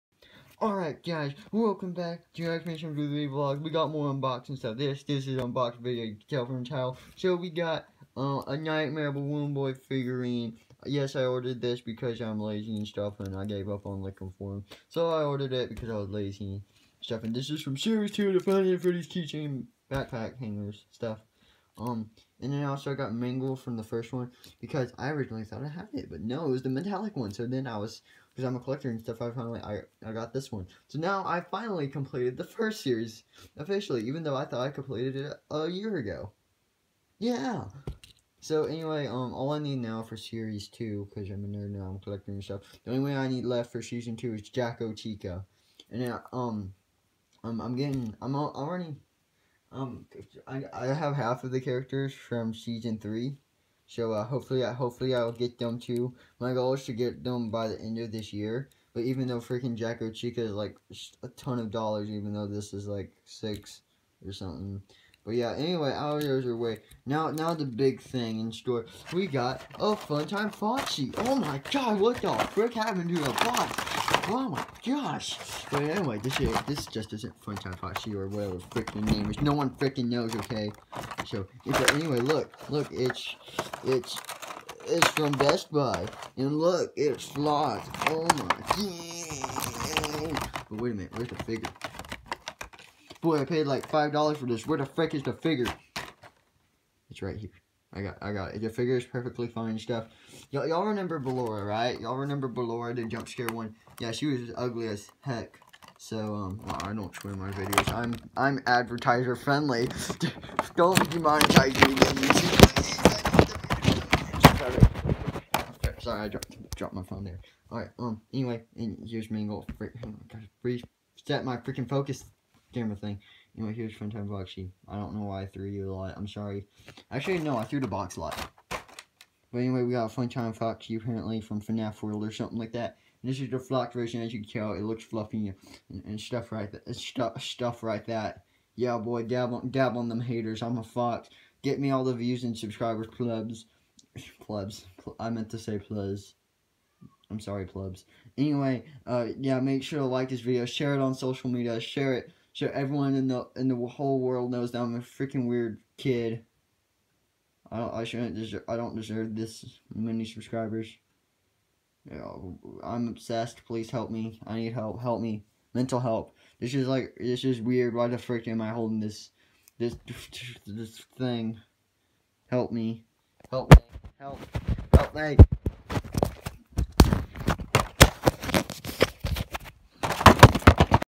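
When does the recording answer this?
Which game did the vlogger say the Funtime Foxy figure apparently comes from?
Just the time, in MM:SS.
02:11.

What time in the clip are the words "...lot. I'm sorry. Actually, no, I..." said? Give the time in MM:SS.
02:05.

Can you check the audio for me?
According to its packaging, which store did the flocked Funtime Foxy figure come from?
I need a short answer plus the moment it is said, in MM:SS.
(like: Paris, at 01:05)
Best Buy, at 01:25.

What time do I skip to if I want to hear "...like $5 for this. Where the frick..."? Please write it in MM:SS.
01:33.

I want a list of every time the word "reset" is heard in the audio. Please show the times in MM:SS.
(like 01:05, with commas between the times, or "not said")
02:00.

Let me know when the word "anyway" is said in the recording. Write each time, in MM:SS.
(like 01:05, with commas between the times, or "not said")
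00:38, 01:05, 01:15, 01:21, 01:58, 02:09, 02:28.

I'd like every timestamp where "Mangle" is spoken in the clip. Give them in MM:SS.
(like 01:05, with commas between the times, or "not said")
00:23, 01:59.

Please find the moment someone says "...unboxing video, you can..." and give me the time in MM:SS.
00:05.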